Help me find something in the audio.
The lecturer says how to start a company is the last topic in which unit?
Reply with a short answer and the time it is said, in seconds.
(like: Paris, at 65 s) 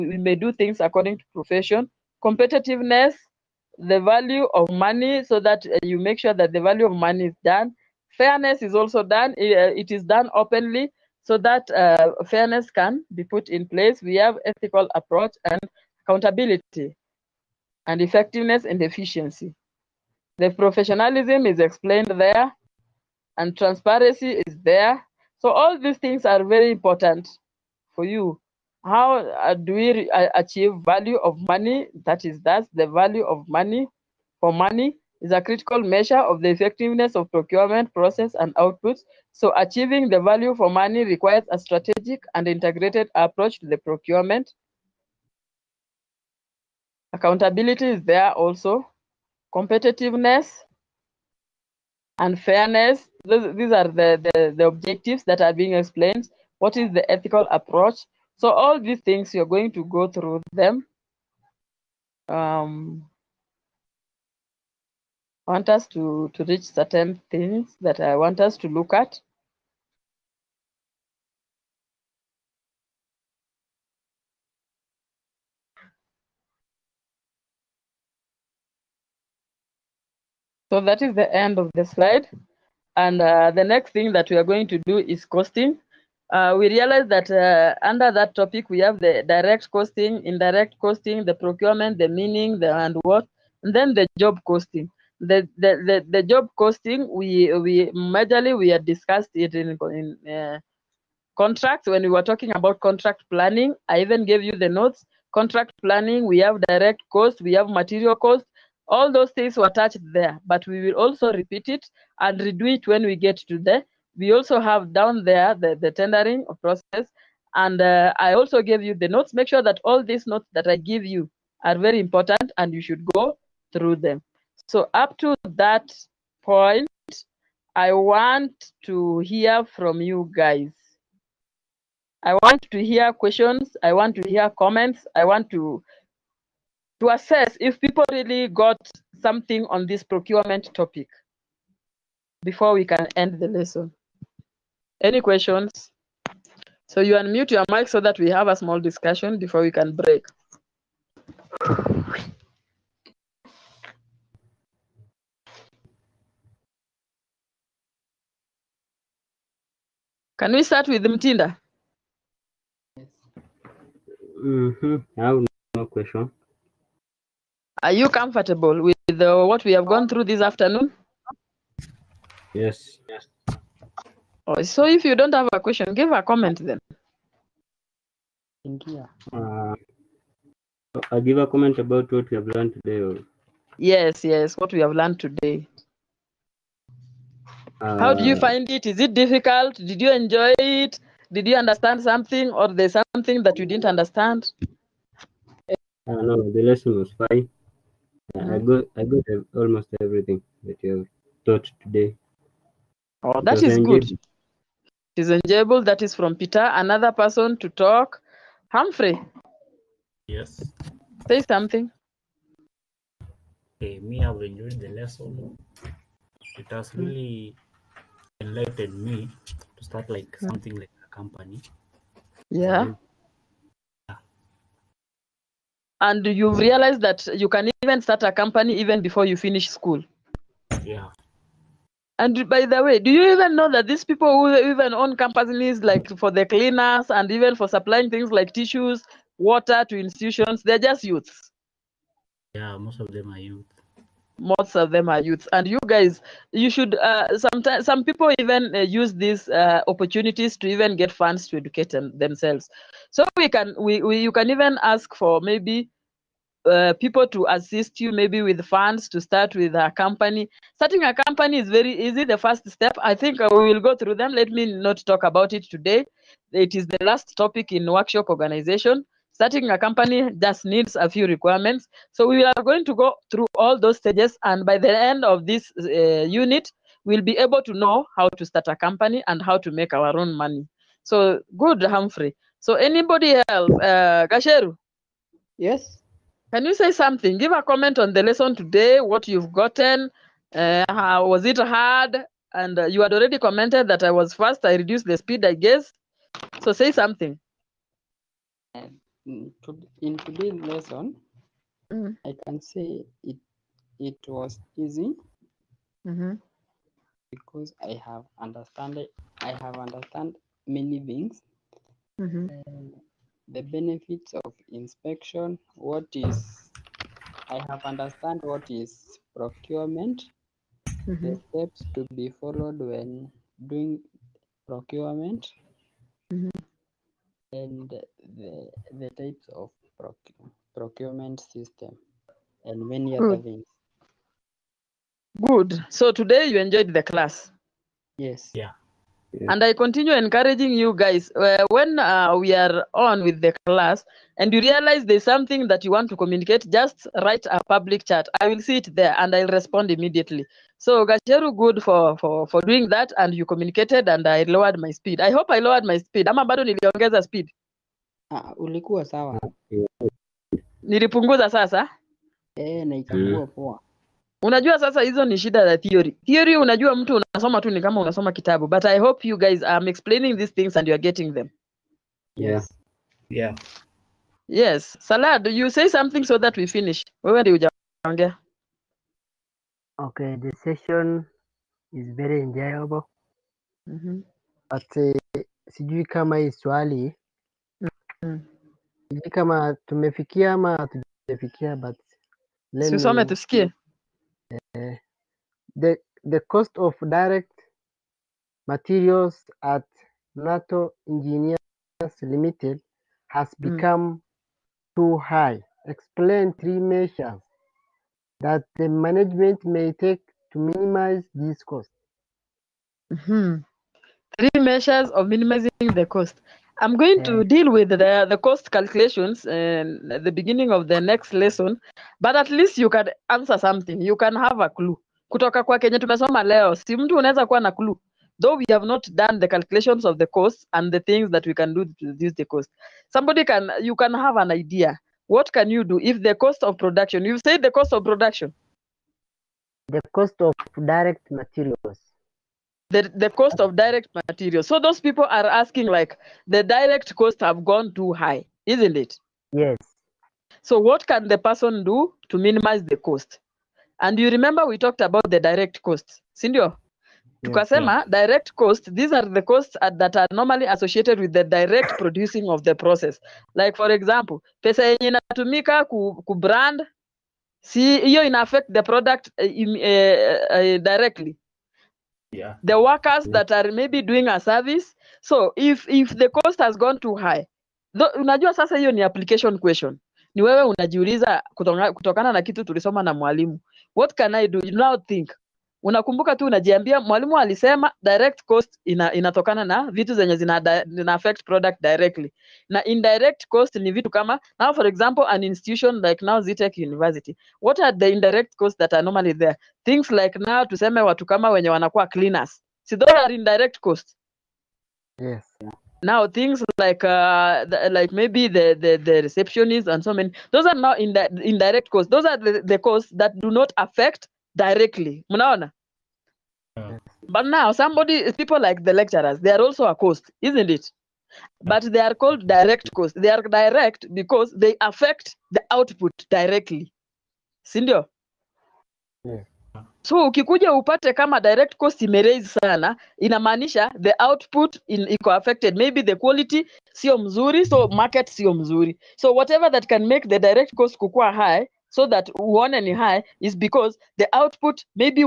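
Workshop organization, at 267 s.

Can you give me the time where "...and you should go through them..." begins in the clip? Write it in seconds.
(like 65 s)
122 s.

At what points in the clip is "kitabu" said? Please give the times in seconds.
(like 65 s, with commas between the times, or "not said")
368 s.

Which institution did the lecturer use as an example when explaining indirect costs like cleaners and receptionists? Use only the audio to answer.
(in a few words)
Zitech University.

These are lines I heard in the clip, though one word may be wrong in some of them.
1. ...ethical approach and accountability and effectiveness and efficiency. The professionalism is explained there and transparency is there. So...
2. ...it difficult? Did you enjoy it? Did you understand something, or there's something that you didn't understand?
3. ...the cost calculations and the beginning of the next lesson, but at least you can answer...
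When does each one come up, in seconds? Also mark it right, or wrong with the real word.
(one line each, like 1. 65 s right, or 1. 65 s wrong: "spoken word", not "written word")
1. 14 s right
2. 188 s right
3. 418 s right.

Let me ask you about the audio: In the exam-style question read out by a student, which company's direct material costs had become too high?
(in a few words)
Nato Engineers Limited.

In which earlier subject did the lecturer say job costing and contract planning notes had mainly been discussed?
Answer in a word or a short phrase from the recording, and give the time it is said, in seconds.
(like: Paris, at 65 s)
Contracts, at 101 s.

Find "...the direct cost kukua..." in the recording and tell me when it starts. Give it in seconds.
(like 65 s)
540 s.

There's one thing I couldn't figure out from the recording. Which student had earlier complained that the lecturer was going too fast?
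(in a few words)
Gacheru.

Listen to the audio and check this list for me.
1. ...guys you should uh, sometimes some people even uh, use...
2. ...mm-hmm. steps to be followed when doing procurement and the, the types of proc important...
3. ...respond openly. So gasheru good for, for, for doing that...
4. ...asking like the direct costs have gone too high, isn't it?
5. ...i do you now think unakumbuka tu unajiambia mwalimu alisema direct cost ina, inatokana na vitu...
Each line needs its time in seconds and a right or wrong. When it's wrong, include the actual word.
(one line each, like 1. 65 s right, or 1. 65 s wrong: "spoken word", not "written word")
1. 245 s right
2. 321 s wrong: "procurement", not "important"
3. 349 s wrong: "immediately", not "openly"
4. 445 s right
5. 484 s right.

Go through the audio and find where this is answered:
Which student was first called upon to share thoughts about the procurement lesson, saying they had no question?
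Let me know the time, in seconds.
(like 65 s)
161 s.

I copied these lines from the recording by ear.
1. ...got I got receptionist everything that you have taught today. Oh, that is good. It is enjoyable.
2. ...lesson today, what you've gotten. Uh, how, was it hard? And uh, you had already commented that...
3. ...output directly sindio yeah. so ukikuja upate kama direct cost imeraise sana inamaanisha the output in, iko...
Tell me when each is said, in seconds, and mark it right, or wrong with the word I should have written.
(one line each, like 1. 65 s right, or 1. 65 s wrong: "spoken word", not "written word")
1. 198 s wrong: "almost", not "receptionist"
2. 288 s right
3. 525 s right.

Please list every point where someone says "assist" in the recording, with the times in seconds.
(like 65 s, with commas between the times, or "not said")
257 s.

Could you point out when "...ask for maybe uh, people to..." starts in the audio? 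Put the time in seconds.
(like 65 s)
254 s.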